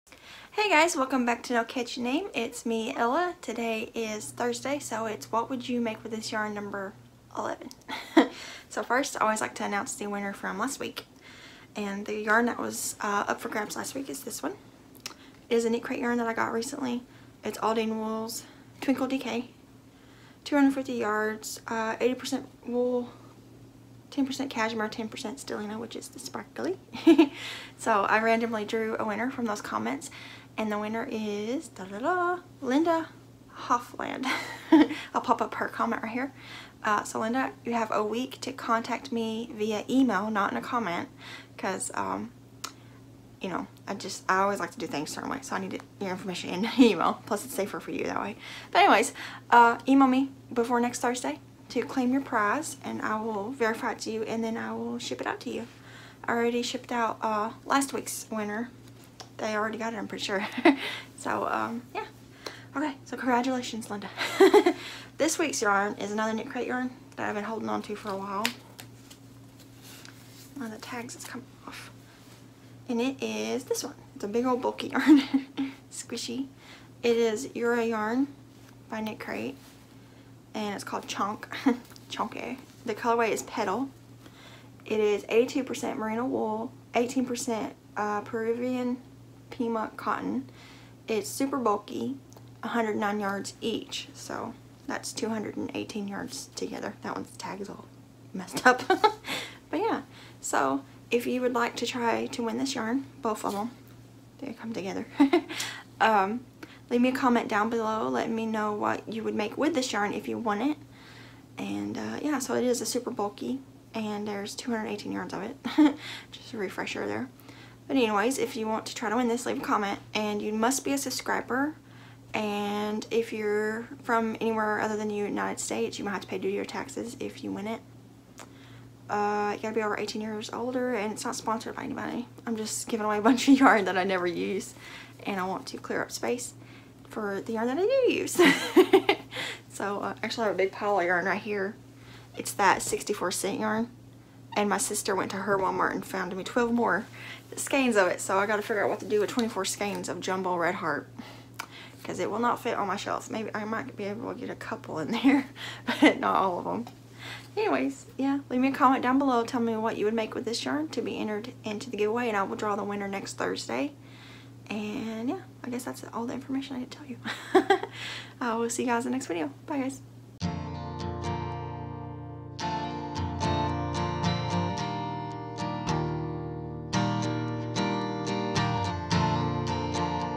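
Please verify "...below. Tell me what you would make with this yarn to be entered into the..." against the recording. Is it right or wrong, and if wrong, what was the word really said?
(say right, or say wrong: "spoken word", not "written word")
right.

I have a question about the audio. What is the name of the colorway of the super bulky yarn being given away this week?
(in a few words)
Petal.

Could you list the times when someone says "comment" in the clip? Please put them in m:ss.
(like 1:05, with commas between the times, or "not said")
0:29, 0:35, 0:40, 1:47, 1:59, 2:38.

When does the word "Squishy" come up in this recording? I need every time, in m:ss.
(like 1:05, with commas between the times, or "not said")
1:15.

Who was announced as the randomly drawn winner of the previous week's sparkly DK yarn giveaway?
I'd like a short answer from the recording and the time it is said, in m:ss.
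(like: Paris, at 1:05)
Linda Hoffland, at 0:32.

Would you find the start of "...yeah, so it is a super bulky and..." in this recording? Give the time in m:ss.
1:52.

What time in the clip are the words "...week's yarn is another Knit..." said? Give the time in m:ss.
1:05.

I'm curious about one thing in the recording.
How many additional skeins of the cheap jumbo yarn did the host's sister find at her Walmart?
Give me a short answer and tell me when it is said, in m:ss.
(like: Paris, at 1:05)
12, at 2:26.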